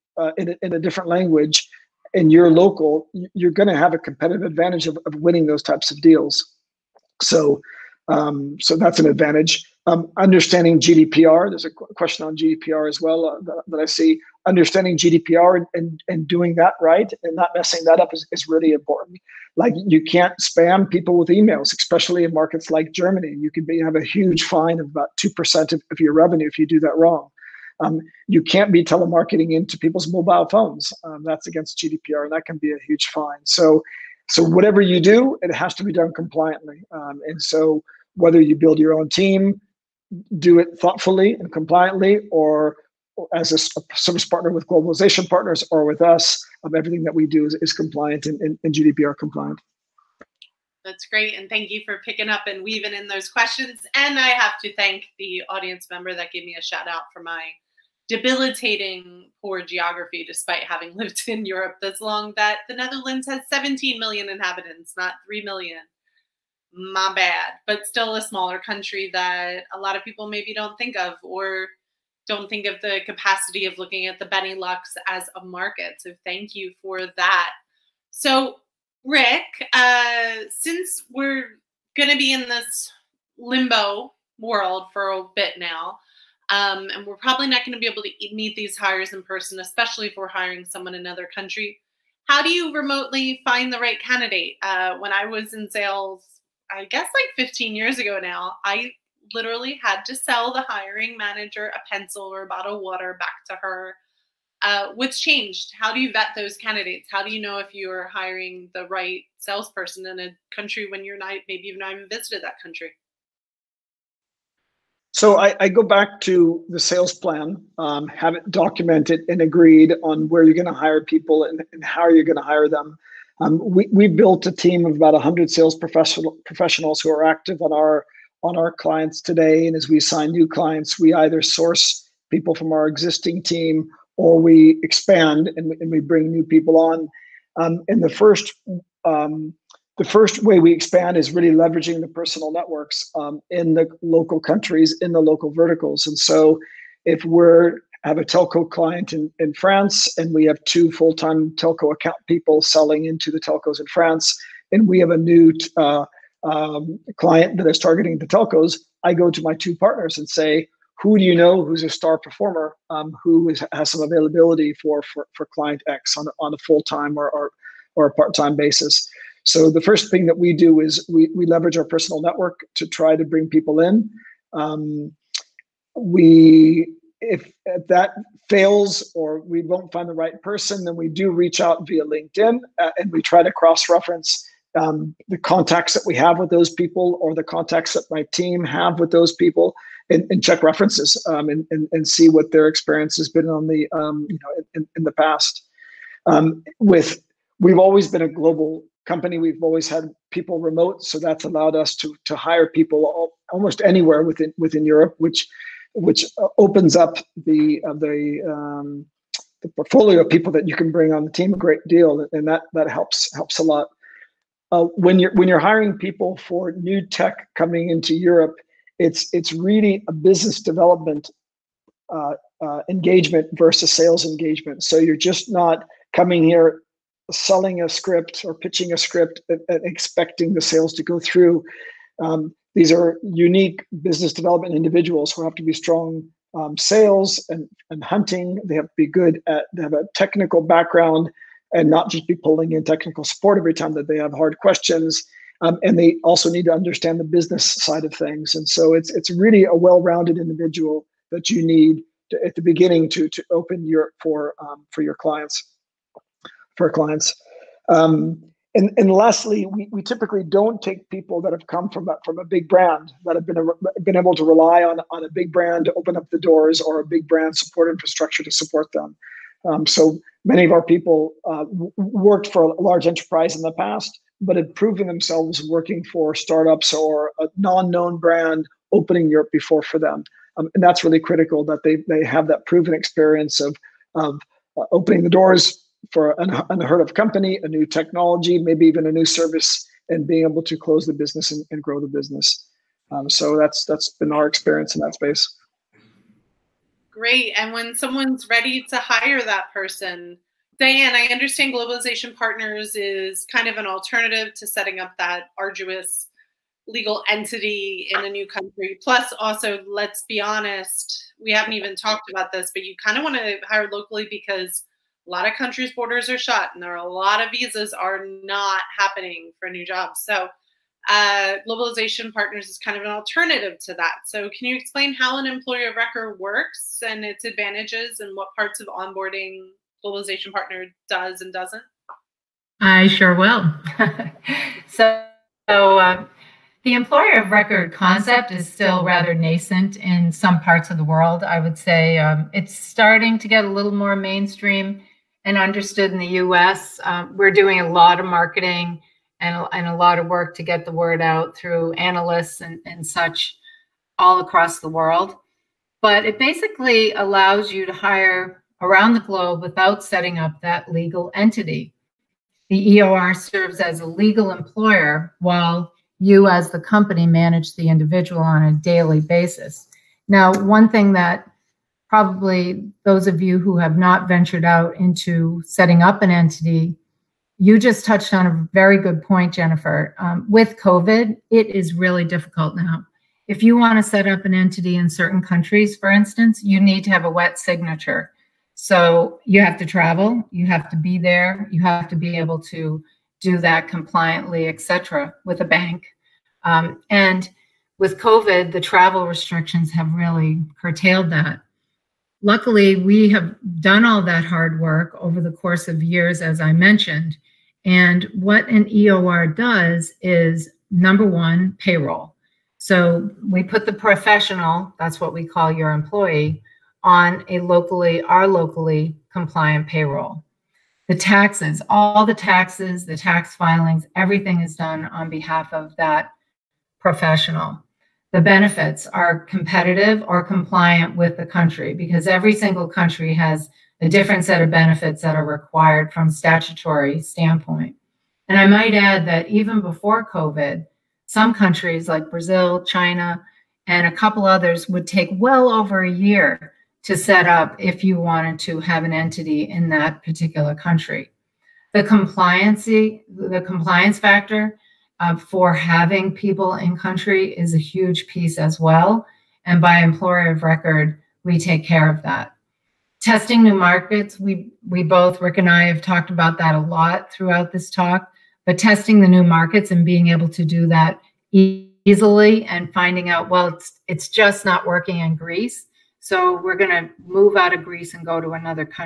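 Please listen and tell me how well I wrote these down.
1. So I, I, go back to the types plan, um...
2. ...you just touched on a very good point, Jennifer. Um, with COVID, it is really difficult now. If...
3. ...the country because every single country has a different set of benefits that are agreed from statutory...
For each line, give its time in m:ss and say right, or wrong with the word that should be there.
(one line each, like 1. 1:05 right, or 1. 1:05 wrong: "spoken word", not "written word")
1. 1:55 wrong: "sales", not "types"
2. 6:17 right
3. 7:11 wrong: "required", not "agreed".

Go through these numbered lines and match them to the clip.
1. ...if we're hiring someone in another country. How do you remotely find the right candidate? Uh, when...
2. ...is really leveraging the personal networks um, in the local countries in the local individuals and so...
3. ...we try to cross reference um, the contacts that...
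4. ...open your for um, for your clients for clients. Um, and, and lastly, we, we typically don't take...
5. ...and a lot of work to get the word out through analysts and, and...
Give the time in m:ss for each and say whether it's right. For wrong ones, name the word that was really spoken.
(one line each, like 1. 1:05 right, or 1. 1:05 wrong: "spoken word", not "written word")
1. 1:30 right
2. 2:21 wrong: "verticals", not "individuals"
3. 3:03 right
4. 4:13 right
5. 5:49 right.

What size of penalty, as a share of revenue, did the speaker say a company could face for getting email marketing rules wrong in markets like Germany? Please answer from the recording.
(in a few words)
2%.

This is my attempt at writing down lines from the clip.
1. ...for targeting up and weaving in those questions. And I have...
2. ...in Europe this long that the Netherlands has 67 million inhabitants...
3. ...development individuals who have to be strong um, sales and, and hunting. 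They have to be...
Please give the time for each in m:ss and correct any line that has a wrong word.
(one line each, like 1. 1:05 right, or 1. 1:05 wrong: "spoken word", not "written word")
1. 0:51 wrong: "picking", not "targeting"
2. 1:01 wrong: "17", not "67"
3. 3:54 right.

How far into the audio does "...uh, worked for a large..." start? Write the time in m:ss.
4:31.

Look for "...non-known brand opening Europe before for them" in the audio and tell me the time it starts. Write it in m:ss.
4:37.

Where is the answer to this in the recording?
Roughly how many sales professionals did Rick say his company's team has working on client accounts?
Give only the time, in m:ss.
2:05.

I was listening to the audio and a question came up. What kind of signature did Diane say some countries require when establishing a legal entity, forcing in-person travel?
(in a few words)
wet signature.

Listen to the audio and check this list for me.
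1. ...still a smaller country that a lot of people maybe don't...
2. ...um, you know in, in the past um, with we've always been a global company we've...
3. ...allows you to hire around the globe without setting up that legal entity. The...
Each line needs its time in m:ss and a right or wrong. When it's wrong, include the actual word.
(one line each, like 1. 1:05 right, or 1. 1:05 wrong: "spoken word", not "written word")
1. 1:07 right
2. 3:13 right
3. 5:57 right.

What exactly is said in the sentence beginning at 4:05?
Um, and they also need to understand the business side of things.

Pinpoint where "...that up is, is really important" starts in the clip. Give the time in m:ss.
0:17.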